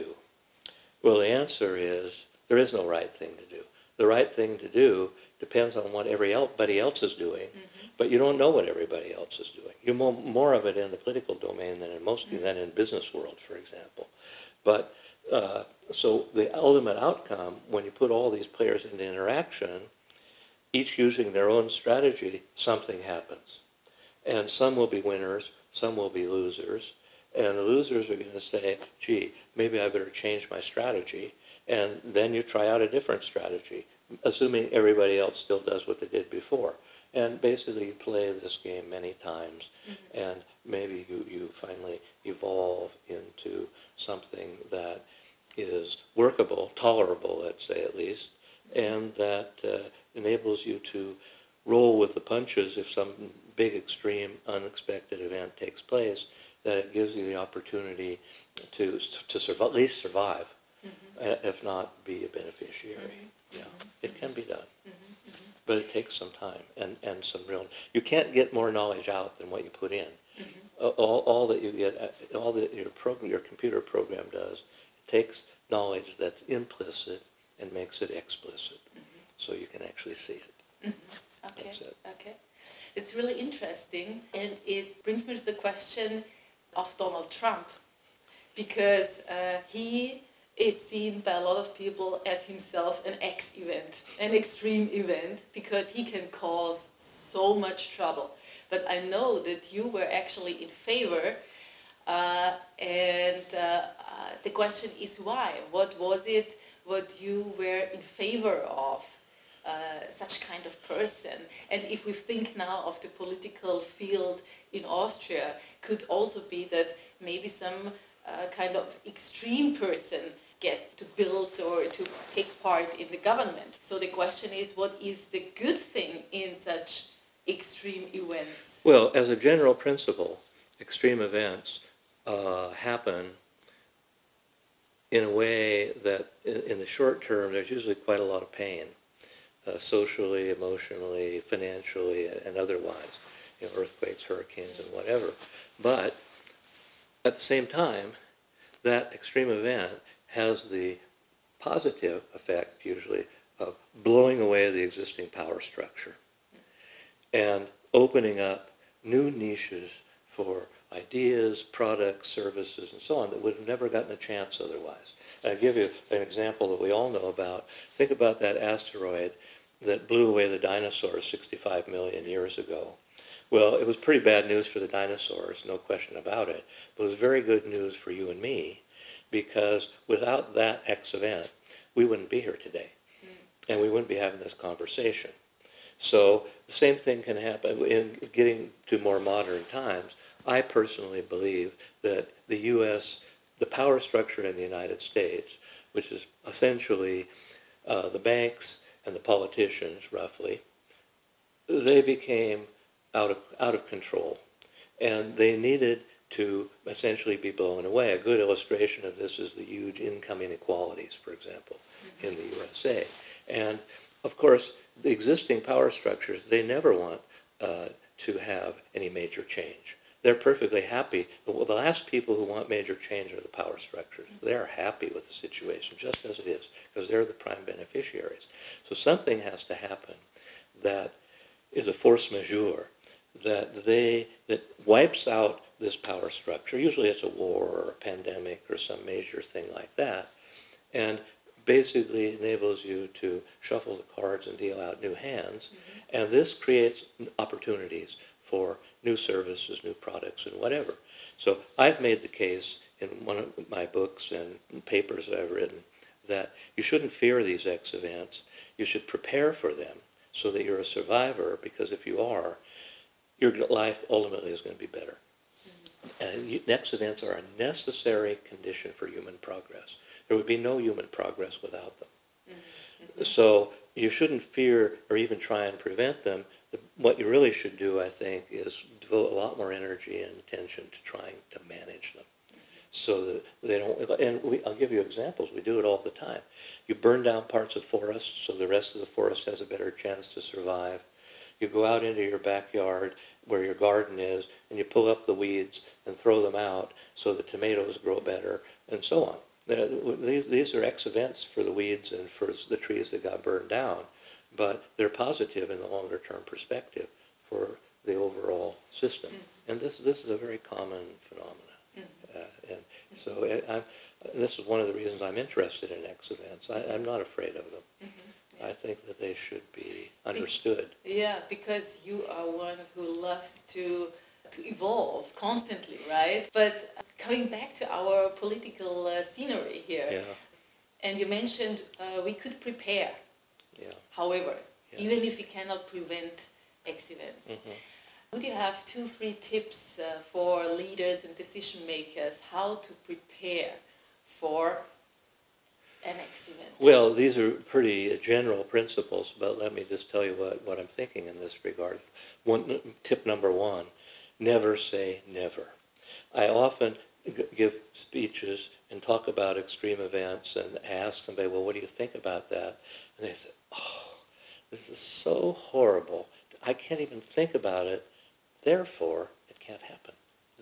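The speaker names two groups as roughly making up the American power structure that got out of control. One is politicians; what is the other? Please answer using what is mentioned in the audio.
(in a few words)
The banks.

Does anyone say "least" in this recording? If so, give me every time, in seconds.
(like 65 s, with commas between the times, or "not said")
47 s, 59 s.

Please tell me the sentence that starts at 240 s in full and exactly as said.
And basically enables you to shuffle the cards and deal out new hands.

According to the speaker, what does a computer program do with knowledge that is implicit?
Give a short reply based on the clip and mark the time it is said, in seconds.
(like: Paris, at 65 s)
Makes it explicit, at 77 s.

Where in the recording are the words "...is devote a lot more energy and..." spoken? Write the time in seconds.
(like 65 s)
278 s.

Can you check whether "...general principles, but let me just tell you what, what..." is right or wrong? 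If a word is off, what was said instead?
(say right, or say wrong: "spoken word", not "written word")
right.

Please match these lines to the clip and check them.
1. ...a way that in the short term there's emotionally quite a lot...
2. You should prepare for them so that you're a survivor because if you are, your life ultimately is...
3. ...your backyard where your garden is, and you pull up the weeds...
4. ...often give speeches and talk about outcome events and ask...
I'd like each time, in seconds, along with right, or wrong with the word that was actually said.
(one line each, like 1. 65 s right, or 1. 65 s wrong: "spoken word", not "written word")
1. 135 s wrong: "usually", not "emotionally"
2. 258 s right
3. 292 s right
4. 356 s wrong: "extreme", not "outcome".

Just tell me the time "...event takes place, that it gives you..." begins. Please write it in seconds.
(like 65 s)
55 s.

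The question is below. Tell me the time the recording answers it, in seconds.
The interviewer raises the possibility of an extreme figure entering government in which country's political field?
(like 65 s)
114 s.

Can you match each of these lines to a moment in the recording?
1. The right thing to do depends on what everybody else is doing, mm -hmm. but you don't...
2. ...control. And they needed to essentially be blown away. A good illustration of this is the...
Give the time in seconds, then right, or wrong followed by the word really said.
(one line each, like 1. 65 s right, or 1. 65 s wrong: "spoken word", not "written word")
1. 3 s right
2. 203 s right.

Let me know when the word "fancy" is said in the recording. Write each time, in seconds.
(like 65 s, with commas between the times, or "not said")
not said.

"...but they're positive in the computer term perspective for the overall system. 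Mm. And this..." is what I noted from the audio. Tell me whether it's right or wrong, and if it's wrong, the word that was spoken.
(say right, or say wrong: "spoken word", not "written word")
wrong: "longer", not "computer".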